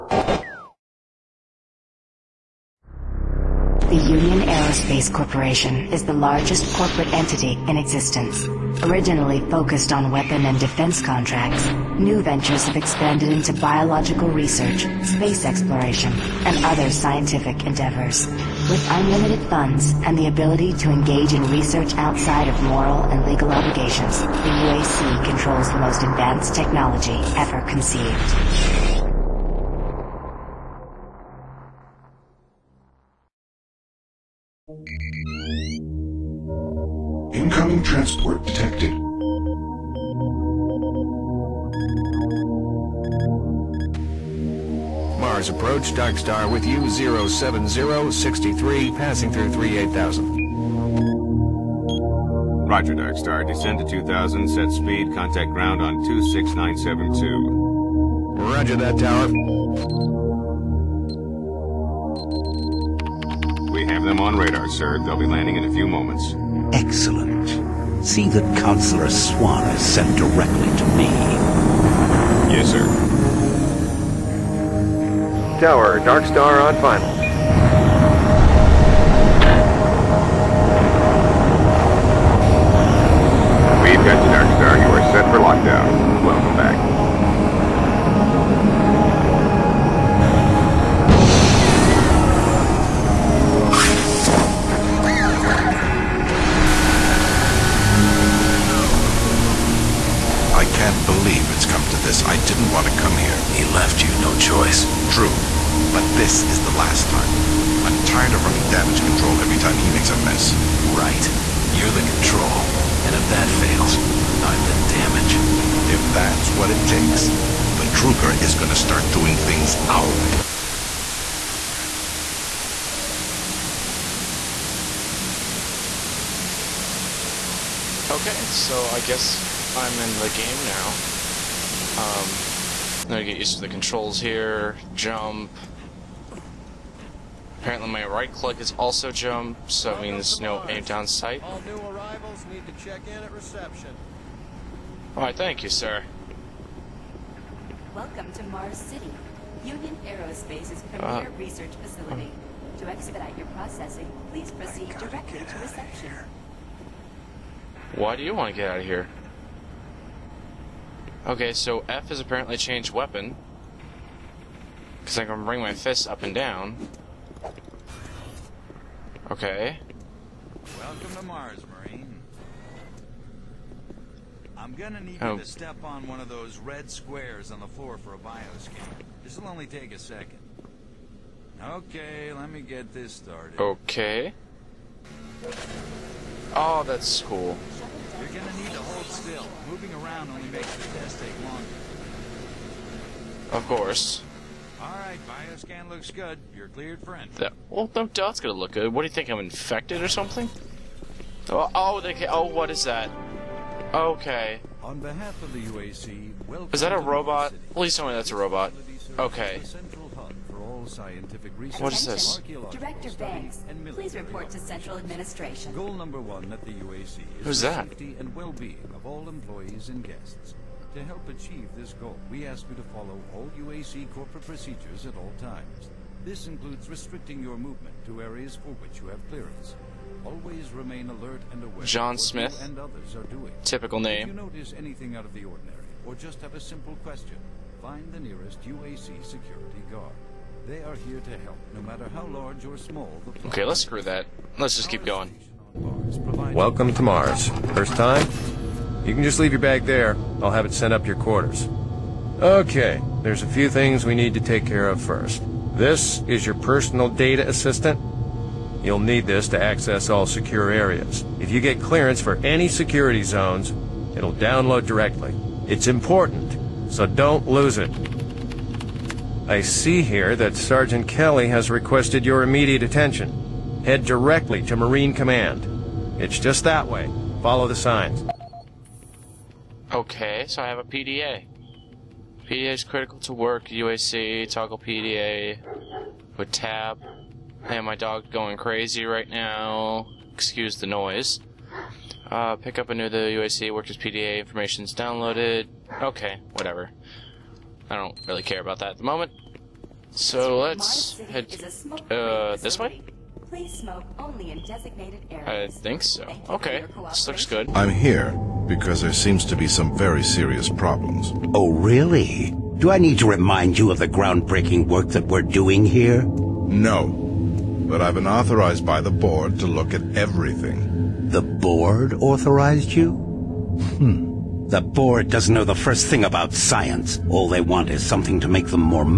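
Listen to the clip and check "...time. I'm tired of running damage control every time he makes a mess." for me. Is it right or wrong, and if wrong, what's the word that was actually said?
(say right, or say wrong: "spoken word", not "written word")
right.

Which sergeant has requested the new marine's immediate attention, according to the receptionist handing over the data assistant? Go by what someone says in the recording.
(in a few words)
Sergeant Kelly.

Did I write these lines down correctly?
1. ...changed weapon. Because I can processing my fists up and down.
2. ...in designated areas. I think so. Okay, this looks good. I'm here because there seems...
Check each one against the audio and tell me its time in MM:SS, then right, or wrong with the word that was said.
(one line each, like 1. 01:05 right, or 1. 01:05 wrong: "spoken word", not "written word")
1. 02:42 wrong: "bring", not "processing"
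2. 05:04 right.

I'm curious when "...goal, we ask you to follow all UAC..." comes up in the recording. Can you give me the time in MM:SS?
03:41.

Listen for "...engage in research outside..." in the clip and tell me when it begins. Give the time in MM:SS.
00:20.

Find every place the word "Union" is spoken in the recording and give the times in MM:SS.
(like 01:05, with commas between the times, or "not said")
00:04, 02:29.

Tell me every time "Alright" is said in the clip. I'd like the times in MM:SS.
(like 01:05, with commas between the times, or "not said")
02:25, 03:14.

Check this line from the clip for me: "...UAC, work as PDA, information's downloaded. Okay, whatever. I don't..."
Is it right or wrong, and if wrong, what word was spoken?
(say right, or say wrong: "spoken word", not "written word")
right.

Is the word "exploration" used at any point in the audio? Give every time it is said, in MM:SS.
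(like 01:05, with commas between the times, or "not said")
00:15.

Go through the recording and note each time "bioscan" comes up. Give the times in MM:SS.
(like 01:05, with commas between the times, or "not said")
02:58, 03:15.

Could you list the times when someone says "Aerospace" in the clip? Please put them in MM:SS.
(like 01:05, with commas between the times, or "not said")
00:04, 02:30.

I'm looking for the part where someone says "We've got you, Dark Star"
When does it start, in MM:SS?
01:23.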